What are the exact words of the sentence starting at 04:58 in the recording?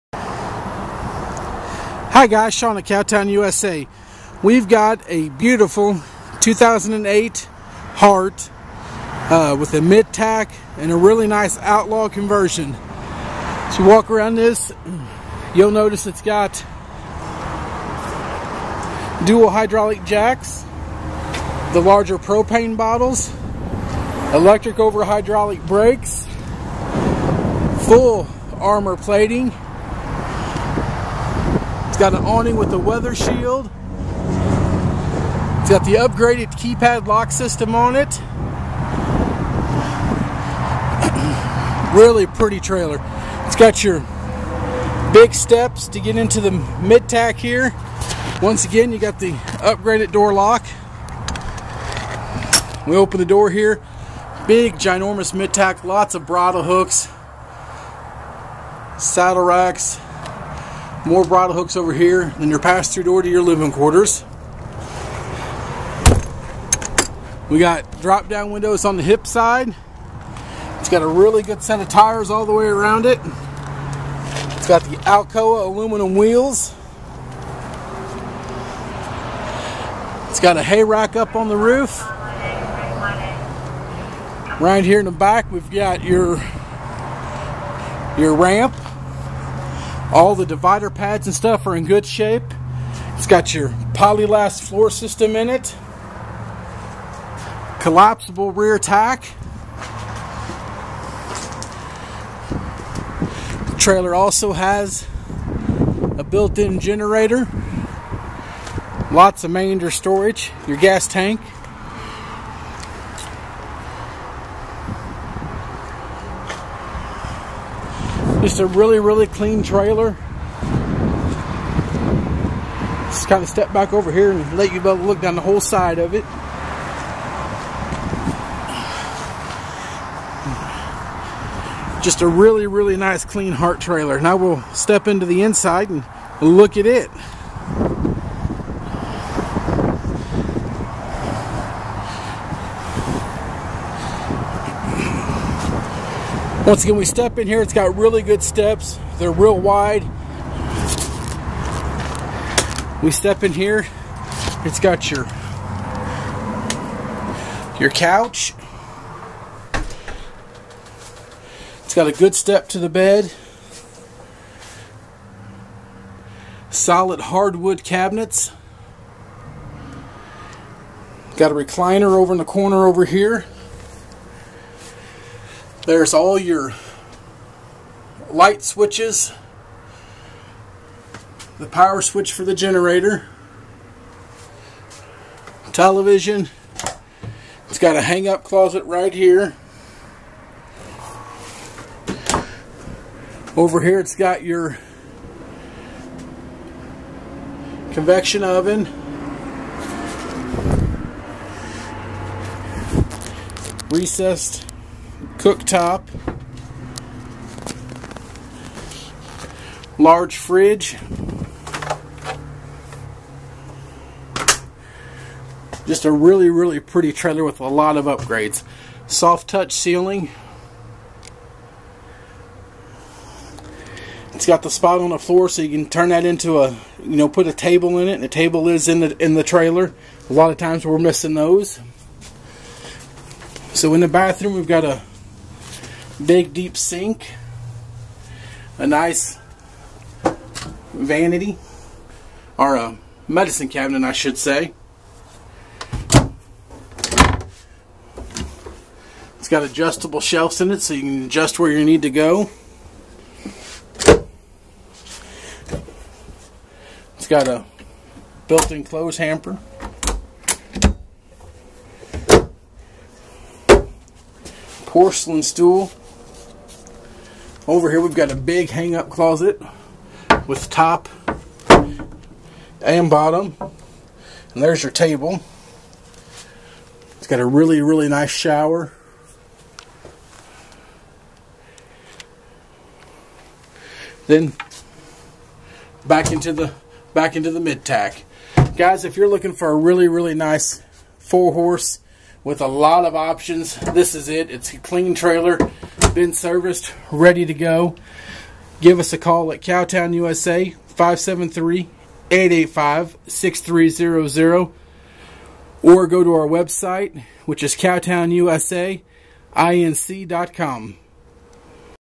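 Give us a call at Cowtown USA 573 885 6300 or go to our website, which is cowtownusainc.com.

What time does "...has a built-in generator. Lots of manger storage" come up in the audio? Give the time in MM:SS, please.
01:44.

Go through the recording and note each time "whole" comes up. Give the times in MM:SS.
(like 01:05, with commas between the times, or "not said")
02:05.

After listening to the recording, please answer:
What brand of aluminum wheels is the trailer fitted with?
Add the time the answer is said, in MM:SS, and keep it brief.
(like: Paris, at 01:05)
Alcoa, at 01:15.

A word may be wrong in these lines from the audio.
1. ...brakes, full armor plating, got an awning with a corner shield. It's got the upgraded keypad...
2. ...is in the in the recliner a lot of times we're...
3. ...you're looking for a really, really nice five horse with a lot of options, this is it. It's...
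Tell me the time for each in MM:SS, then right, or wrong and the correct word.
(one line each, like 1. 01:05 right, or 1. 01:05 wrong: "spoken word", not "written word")
1. 00:25 wrong: "weather", not "corner"
2. 03:48 wrong: "trailer", not "recliner"
3. 04:49 wrong: "four", not "five".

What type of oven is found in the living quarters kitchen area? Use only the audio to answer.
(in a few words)
convection oven.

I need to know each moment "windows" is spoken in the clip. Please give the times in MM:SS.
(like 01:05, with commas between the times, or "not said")
01:08.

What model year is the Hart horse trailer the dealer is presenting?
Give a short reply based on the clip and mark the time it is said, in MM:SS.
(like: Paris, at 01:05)
2008, at 00:06.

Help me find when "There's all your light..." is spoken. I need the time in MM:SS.
02:55.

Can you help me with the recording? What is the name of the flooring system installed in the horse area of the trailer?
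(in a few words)
polylast.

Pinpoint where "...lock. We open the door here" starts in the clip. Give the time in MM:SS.
00:50.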